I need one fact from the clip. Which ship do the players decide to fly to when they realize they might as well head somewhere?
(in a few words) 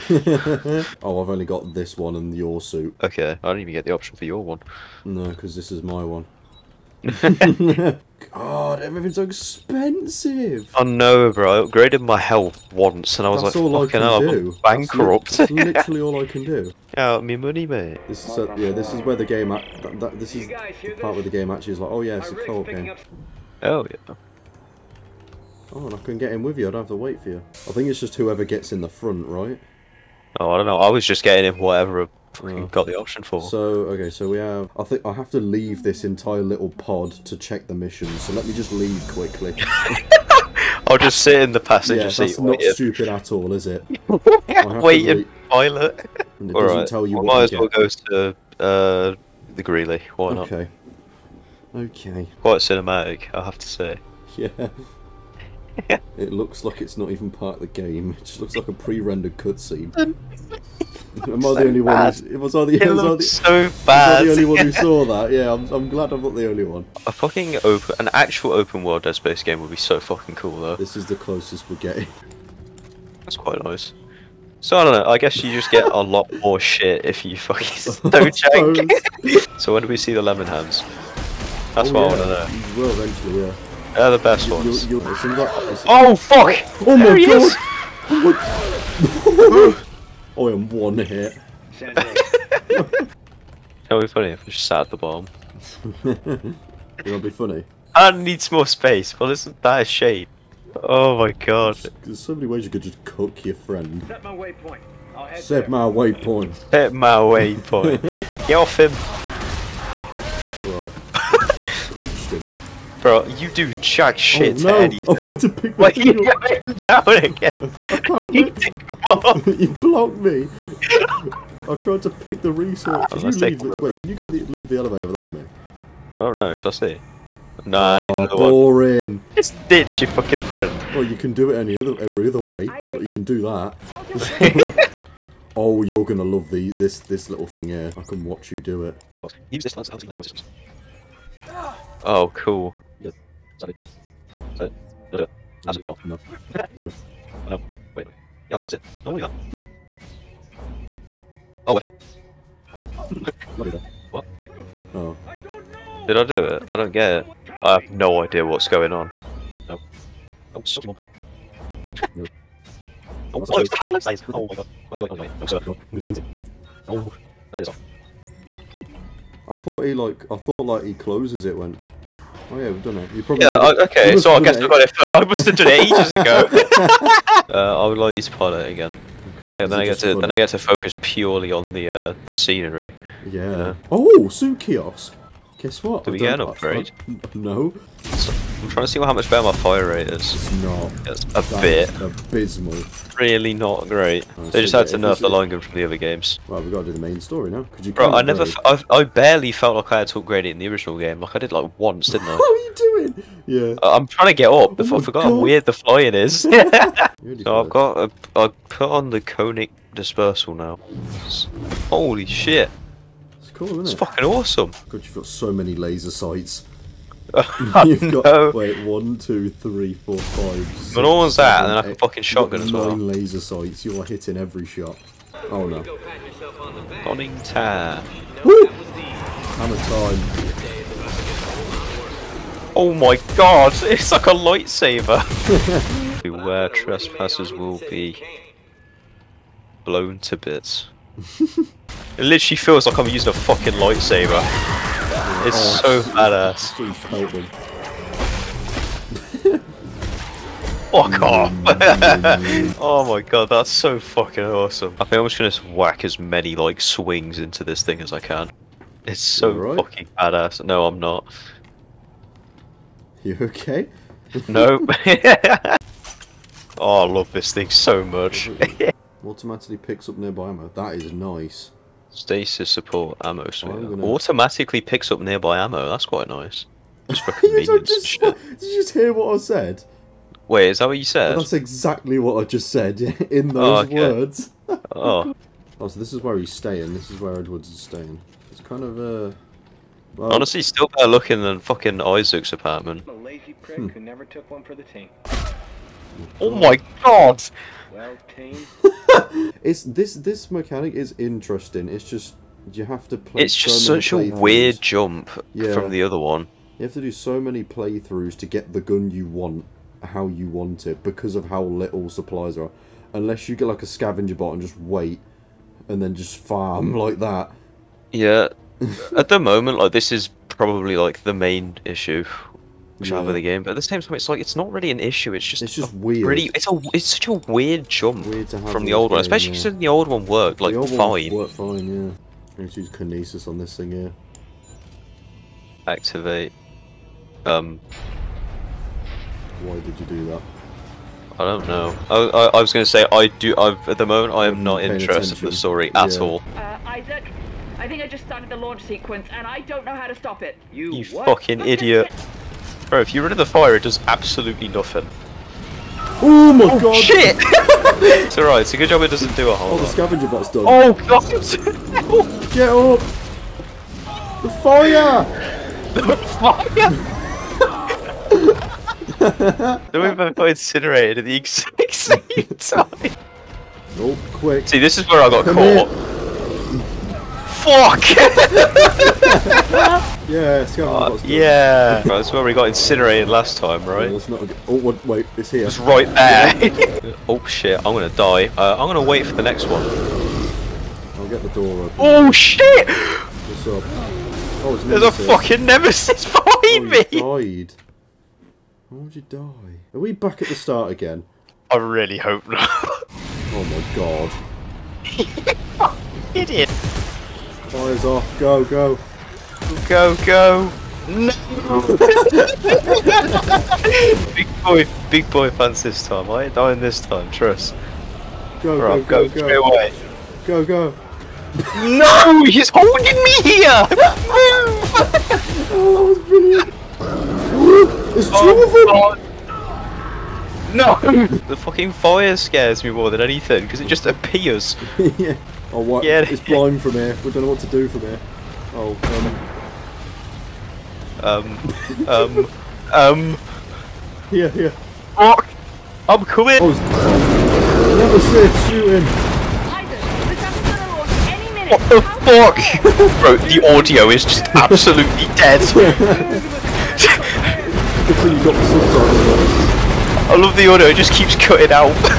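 The Greely.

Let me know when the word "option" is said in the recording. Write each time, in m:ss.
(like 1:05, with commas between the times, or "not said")
0:03, 0:32.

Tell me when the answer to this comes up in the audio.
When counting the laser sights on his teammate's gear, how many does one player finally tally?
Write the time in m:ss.
3:42.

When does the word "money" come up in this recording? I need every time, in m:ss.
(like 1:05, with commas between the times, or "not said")
0:17.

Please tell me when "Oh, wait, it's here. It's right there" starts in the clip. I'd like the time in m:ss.
6:24.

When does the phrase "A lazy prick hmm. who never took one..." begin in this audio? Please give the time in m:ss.
4:53.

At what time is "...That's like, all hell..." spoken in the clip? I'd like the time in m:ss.
0:13.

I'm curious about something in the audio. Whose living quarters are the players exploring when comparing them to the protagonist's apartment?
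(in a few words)
Edwards.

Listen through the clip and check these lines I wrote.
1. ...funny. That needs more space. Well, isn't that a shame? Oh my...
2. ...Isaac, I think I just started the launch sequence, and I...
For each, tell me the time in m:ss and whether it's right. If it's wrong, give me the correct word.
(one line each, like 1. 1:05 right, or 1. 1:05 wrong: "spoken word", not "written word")
1. 1:37 right
2. 5:46 right.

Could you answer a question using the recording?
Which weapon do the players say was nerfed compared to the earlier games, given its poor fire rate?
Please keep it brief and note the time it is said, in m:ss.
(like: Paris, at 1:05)
line gun, at 3:15.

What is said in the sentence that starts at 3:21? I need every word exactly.
Like I did like once, didn't I?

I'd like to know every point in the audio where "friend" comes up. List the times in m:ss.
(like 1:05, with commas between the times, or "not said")
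1:43, 2:10.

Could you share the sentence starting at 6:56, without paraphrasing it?
I ain't dying this time, trust.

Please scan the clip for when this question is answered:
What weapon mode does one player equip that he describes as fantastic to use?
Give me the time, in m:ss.
3:29.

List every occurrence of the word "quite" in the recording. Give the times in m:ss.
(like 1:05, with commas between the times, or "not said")
0:52, 1:13, 4:36.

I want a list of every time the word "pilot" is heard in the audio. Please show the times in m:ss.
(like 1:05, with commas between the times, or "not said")
0:45, 2:58.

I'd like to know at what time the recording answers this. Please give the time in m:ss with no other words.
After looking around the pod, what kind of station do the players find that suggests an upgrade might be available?
3:04.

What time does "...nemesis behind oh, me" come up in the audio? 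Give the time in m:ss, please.
6:35.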